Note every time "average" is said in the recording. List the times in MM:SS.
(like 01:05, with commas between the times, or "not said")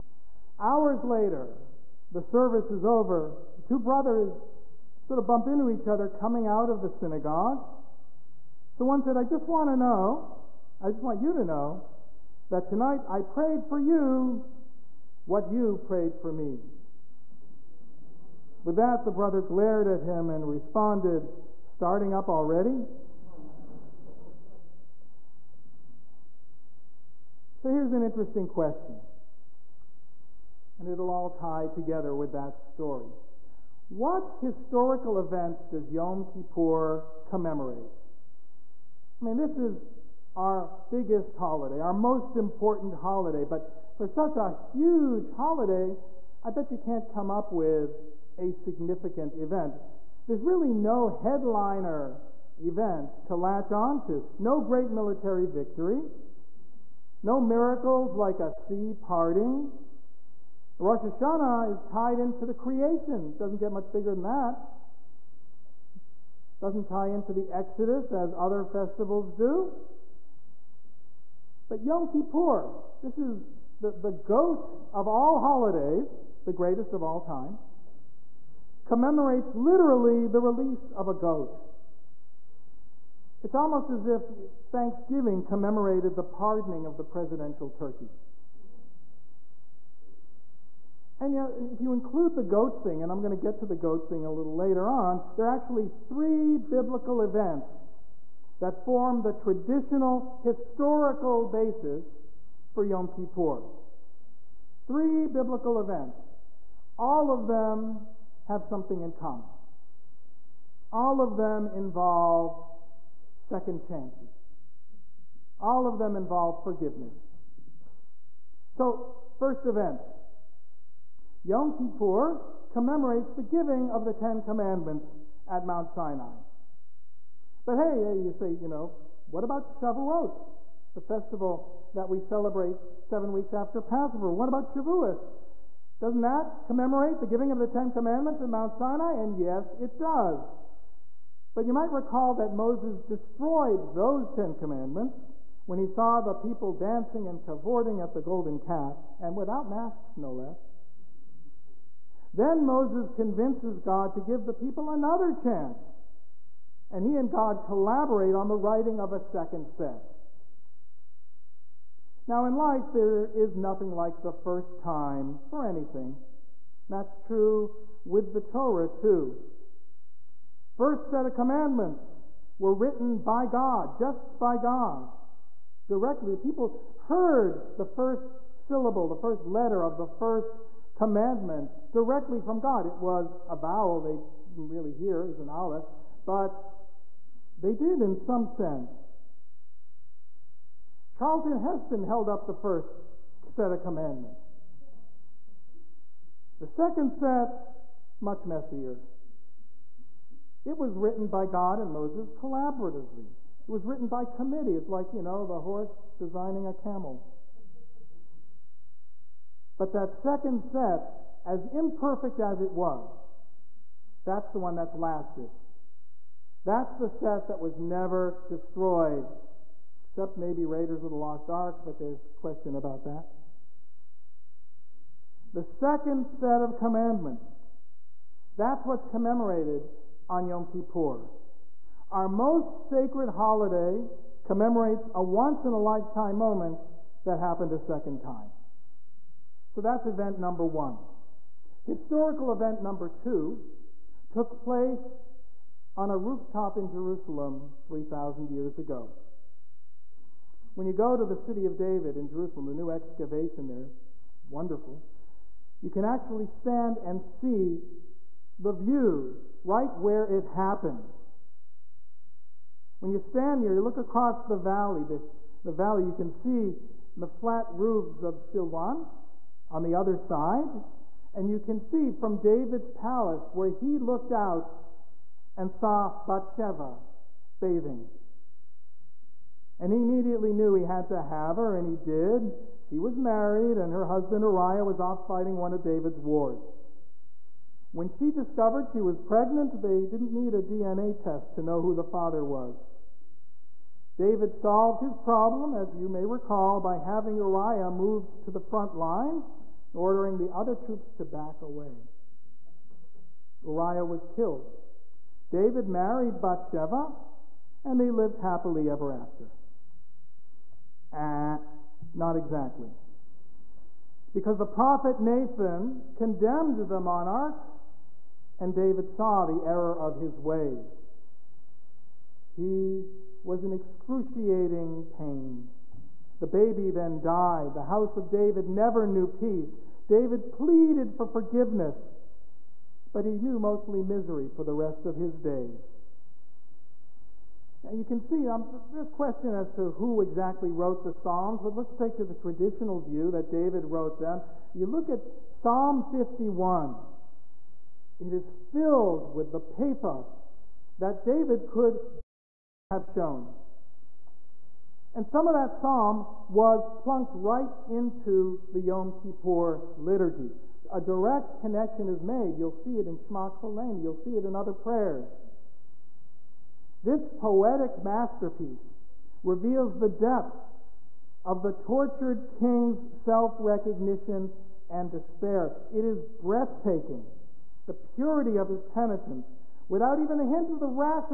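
not said.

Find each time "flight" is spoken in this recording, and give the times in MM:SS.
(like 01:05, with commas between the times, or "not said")
not said.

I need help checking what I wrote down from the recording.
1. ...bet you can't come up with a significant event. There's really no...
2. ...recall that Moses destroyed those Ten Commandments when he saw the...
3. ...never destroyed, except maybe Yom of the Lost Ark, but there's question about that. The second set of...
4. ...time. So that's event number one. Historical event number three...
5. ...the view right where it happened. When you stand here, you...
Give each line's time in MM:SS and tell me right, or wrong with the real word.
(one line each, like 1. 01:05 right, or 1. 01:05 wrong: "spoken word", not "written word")
1. 00:46 right
2. 02:21 right
3. 03:37 wrong: "Raiders", not "Yom"
4. 03:58 wrong: "two", not "three"
5. 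04:18 right.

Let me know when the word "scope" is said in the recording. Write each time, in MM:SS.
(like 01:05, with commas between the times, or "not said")
not said.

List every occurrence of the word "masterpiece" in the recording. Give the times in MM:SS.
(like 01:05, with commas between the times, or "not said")
06:08.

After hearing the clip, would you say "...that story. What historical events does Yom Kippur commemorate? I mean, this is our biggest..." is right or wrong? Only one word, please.
right.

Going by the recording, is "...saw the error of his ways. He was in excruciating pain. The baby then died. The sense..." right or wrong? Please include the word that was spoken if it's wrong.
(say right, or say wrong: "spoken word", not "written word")
wrong: "house", not "sense".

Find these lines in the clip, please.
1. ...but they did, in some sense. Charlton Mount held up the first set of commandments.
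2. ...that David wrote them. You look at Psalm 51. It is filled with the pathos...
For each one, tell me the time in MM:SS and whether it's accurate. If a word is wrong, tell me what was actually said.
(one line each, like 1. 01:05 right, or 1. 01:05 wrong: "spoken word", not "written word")
1. 03:06 wrong: "Heston", not "Mount"
2. 05:43 right.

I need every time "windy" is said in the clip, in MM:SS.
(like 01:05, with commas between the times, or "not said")
not said.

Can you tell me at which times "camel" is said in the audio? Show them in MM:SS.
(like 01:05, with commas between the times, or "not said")
03:26.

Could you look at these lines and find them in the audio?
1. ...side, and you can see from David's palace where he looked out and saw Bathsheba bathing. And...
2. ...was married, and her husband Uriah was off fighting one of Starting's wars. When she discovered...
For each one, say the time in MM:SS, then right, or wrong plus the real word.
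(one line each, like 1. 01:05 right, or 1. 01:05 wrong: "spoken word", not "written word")
1. 04:30 right
2. 04:42 wrong: "David", not "Starting".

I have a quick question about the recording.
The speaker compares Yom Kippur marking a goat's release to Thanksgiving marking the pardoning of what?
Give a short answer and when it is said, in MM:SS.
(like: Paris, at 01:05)
the presidential turkey, at 01:27.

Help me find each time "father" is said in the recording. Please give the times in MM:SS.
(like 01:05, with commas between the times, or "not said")
04:52.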